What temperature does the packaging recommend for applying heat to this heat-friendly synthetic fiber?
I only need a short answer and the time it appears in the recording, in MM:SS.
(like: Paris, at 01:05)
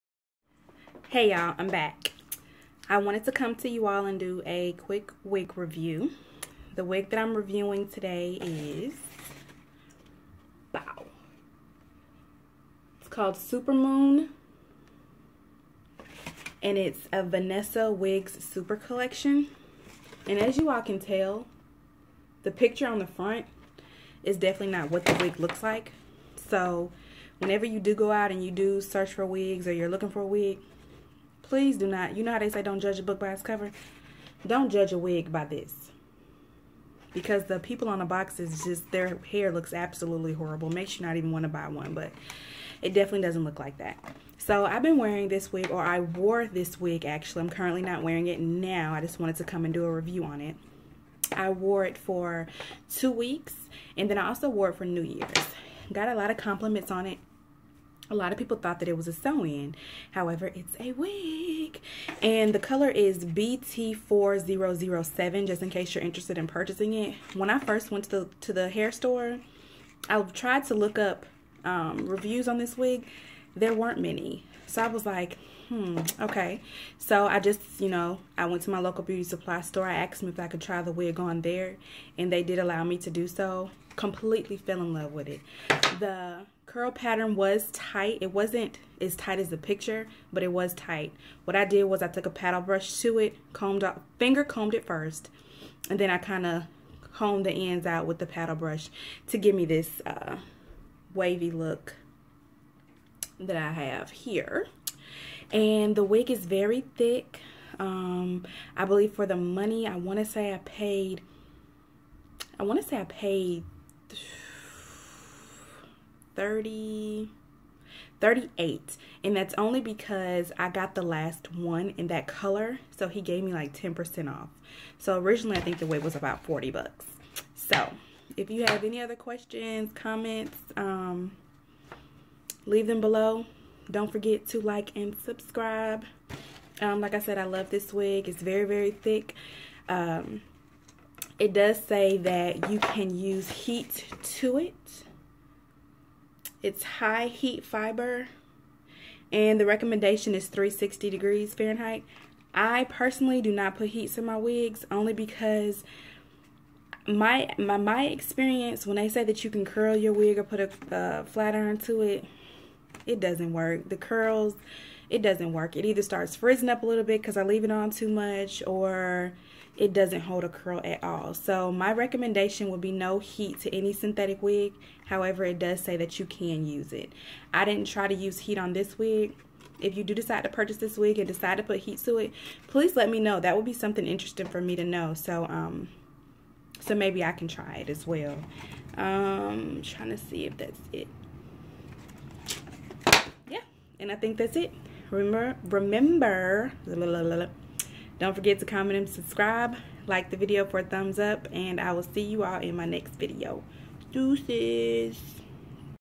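360 degrees Fahrenheit, at 02:30.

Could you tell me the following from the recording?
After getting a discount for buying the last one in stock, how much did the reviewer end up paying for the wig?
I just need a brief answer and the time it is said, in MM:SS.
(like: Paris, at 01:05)
$38, at 01:58.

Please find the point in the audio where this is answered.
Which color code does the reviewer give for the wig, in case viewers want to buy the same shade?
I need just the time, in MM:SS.
01:03.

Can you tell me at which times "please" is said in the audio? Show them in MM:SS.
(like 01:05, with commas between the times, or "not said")
00:31, 03:02.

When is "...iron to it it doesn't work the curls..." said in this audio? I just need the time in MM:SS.
02:41.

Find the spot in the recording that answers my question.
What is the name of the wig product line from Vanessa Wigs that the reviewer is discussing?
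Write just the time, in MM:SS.
00:13.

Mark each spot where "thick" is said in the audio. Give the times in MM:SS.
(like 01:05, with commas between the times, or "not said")
01:46, 02:18.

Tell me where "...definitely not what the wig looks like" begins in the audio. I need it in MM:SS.
00:24.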